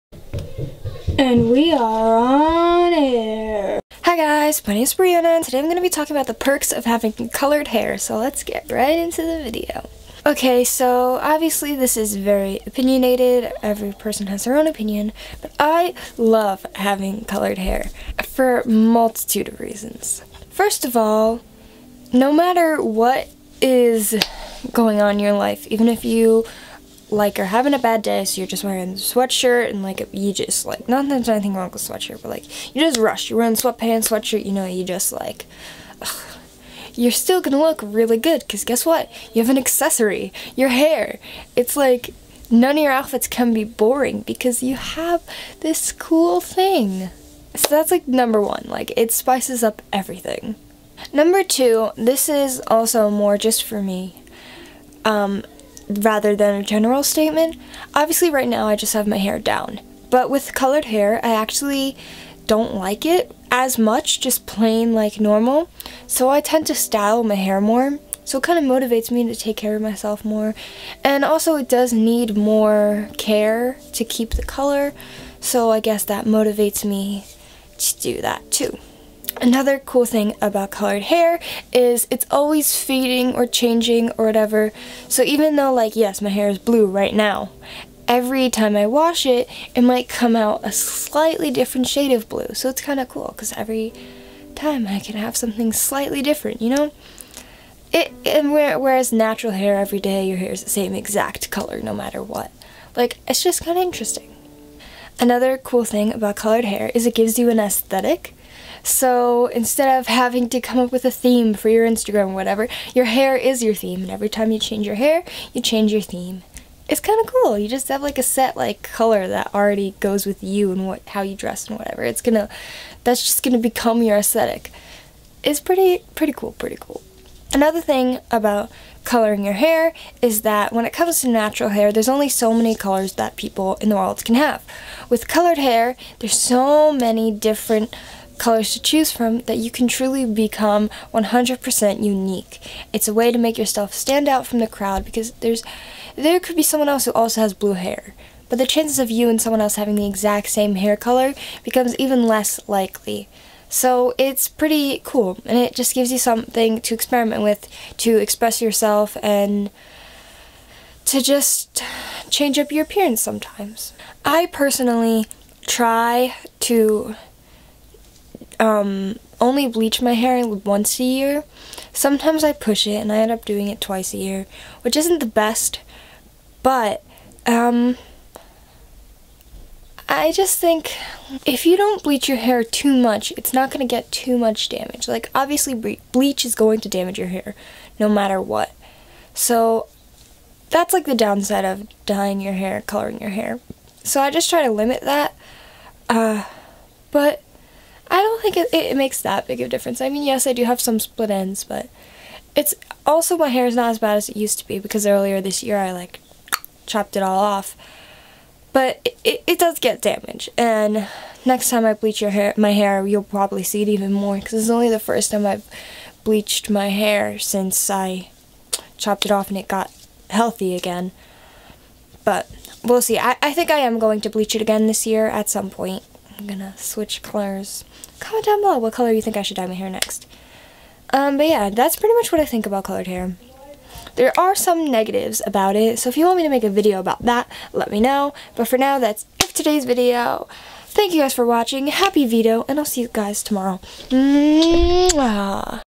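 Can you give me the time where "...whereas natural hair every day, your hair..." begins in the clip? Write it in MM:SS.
01:38.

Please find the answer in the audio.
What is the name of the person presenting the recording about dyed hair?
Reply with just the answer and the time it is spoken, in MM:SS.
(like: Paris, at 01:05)
Brianna, at 00:04.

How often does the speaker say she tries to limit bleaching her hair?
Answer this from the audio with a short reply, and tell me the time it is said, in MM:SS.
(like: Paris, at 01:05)
Once a year, at 02:50.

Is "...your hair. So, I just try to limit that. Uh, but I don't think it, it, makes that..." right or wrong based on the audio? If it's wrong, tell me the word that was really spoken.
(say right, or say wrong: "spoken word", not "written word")
right.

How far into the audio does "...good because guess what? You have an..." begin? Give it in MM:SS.
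00:38.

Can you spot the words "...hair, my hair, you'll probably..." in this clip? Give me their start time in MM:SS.
03:32.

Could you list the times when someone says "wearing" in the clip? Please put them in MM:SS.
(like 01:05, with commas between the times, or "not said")
00:28, 00:33.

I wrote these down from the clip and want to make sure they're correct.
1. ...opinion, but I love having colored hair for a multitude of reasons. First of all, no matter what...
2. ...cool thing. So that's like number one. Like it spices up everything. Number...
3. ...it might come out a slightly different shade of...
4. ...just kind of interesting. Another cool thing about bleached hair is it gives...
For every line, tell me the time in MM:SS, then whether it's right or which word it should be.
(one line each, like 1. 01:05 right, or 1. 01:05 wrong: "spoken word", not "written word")
1. 00:14 right
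2. 00:45 right
3. 01:29 right
4. 01:43 wrong: "colored", not "bleached".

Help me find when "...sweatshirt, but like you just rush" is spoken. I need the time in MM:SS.
00:31.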